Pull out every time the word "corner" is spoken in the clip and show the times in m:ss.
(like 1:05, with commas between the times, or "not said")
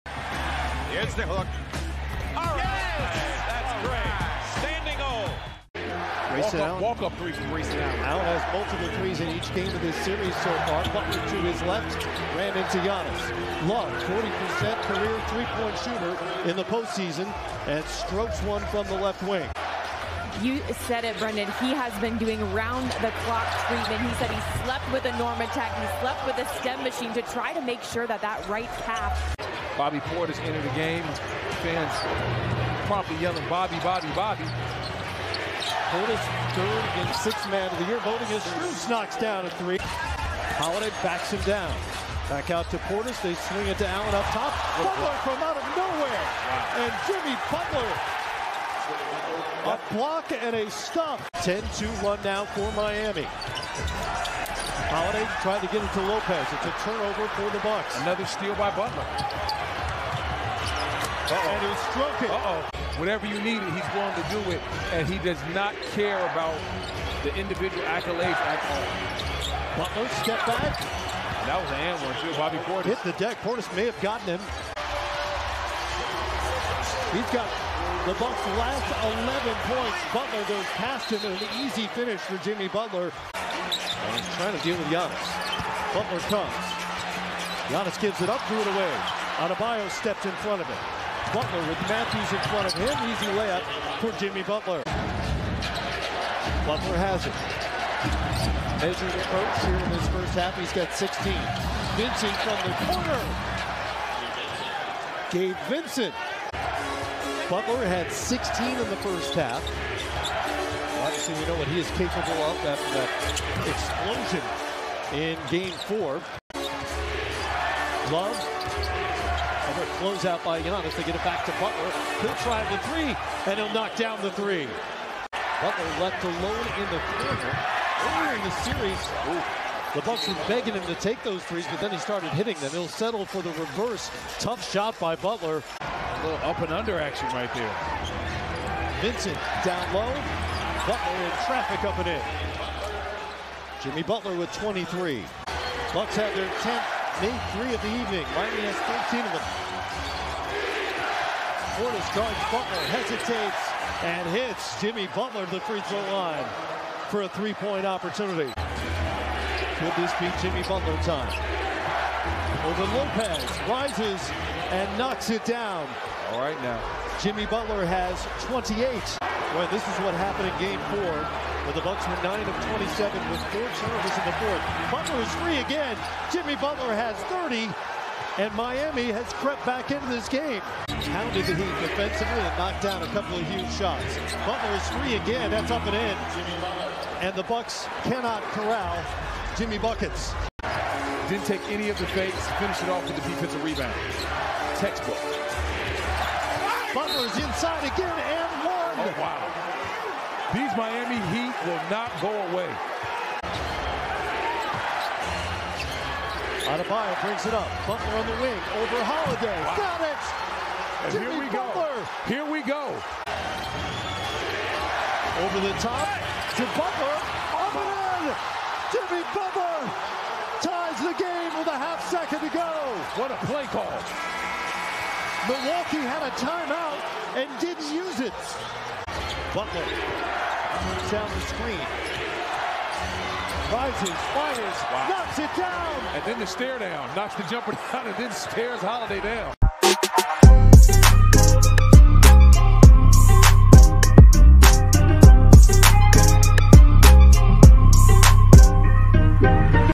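1:42, 2:07.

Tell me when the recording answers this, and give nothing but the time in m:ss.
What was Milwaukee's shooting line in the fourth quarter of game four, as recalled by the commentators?
2:52.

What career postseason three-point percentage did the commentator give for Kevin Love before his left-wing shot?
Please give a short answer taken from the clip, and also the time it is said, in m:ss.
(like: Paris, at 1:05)
40%, at 0:14.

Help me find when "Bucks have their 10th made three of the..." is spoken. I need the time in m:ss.
2:25.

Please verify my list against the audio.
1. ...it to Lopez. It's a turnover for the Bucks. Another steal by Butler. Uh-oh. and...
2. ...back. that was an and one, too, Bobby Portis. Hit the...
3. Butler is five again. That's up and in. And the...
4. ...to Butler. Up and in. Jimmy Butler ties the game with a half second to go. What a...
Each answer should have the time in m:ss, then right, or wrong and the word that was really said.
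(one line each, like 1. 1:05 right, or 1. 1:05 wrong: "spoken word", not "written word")
1. 0:55 right
2. 1:10 right
3. 3:04 wrong: "three", not "five"
4. 3:36 right.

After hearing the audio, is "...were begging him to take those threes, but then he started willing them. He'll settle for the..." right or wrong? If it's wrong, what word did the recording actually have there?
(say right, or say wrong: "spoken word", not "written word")
wrong: "hitting", not "willing".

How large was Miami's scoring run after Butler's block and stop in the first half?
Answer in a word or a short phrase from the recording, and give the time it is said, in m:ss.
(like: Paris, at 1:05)
10-2, at 0:51.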